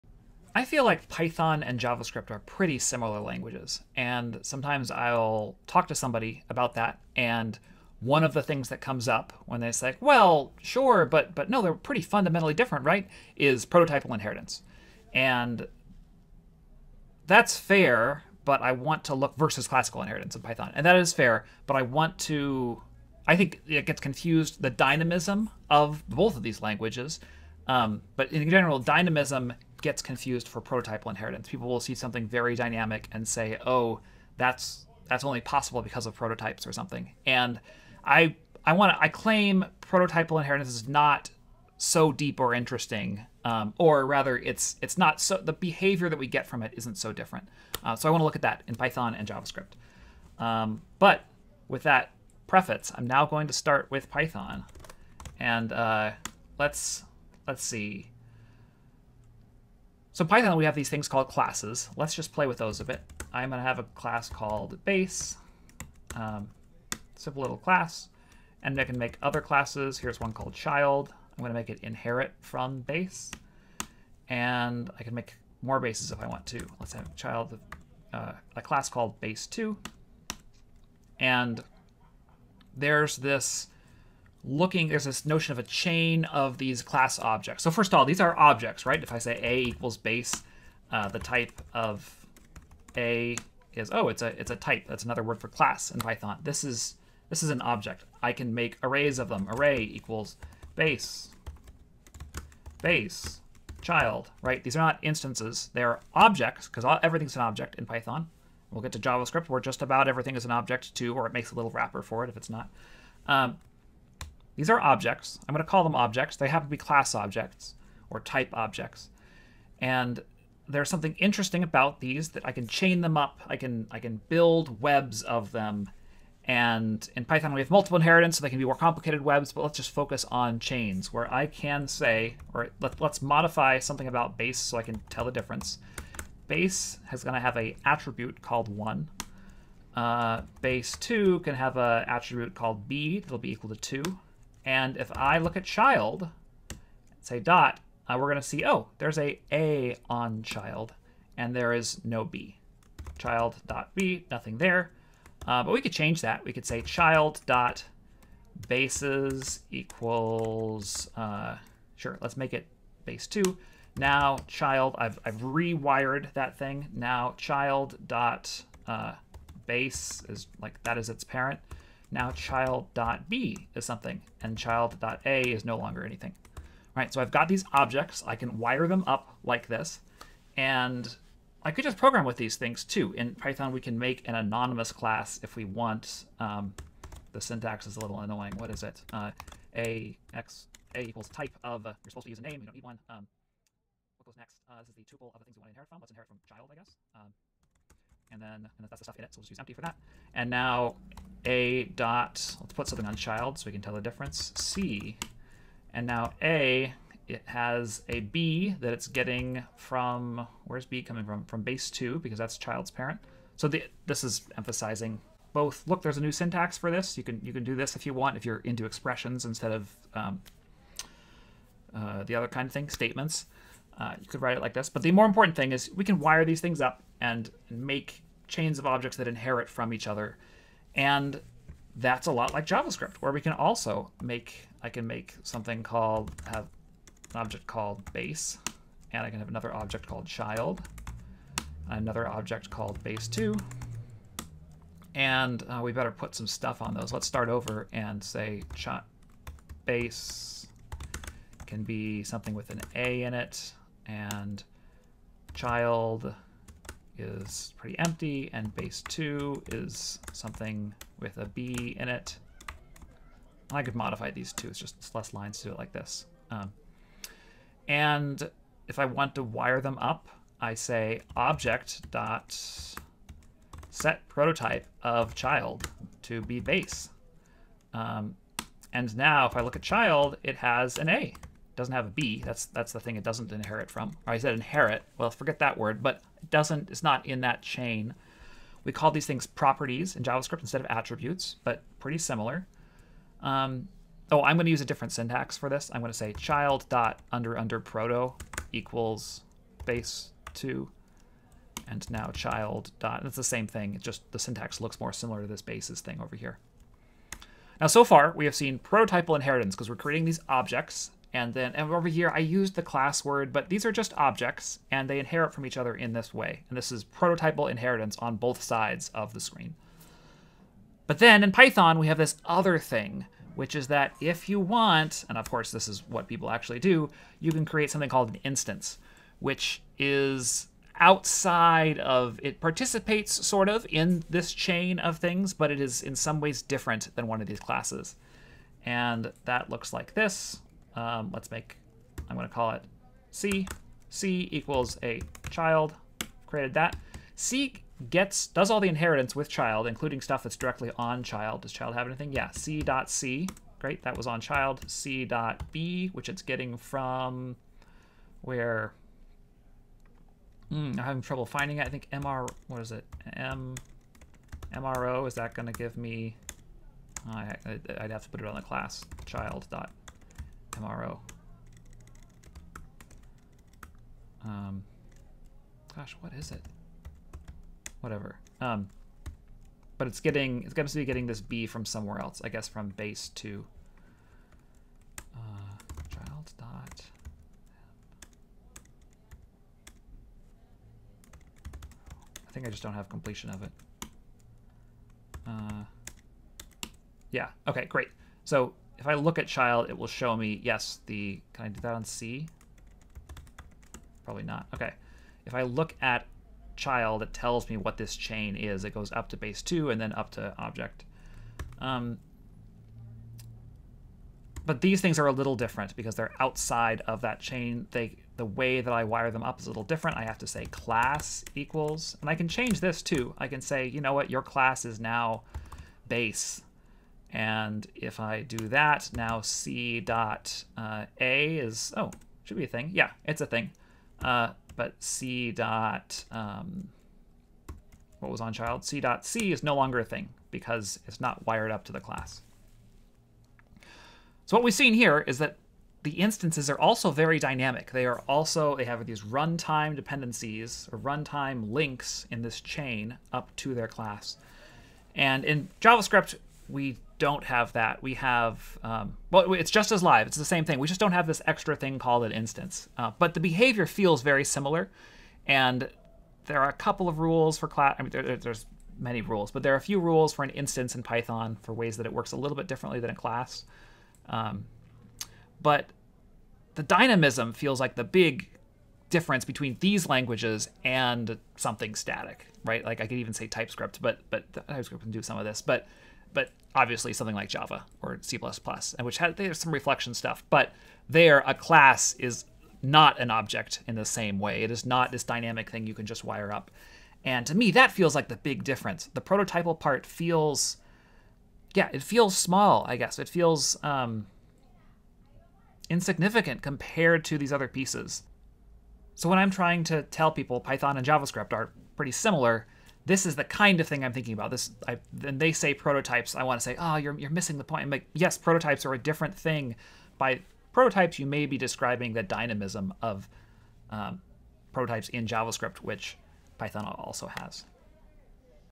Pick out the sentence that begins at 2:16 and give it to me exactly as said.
Base is going to have a attribute called 1.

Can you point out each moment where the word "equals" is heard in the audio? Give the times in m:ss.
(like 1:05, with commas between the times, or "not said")
1:29, 1:39, 2:23, 2:39, 3:11, 4:58, 5:44, 7:01.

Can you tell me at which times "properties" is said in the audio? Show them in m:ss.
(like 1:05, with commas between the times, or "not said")
4:49.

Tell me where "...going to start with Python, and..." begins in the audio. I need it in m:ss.
0:53.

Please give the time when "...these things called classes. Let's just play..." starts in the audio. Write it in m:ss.
1:00.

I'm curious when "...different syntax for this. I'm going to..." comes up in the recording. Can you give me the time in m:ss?
4:54.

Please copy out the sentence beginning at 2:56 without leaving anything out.
All right, so I've got these objects.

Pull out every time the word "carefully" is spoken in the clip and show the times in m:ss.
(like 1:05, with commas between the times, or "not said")
not said.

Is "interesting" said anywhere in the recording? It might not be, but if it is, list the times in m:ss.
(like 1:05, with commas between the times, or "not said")
0:42, 2:01.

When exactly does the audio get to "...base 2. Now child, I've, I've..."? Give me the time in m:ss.
2:43.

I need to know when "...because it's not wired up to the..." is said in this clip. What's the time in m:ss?
7:20.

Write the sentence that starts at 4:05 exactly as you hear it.
And uh, we better put some stuff on those.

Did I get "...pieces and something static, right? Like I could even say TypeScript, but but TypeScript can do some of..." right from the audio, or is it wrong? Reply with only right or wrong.
wrong.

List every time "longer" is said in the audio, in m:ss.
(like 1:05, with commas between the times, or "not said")
2:55, 7:19.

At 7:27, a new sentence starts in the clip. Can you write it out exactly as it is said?
They are also, they have these runtime dependencies or runtime links in this chain up to their class.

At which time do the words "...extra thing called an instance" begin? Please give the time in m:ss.
7:41.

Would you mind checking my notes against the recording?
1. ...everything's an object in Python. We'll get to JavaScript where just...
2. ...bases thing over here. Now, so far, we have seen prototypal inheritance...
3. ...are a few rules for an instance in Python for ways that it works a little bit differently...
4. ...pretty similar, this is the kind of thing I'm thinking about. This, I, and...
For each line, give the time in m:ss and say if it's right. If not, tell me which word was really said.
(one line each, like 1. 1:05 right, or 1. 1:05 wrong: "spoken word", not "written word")
1. 1:47 right
2. 5:05 right
3. 7:49 right
4. 8:31 right.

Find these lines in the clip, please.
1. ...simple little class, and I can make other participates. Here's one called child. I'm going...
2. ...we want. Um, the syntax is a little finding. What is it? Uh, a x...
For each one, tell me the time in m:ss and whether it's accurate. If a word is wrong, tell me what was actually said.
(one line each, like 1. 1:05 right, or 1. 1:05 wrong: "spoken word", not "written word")
1. 1:07 wrong: "classes", not "participates"
2. 3:05 wrong: "annoying", not "finding".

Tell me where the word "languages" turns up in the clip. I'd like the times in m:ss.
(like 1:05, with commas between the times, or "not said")
0:03, 0:26, 8:00.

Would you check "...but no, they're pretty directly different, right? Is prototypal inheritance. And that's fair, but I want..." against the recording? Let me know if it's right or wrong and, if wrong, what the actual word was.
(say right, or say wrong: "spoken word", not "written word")
wrong: "fundamentally", not "directly".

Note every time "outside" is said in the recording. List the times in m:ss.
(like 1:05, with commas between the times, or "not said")
5:30, 6:56.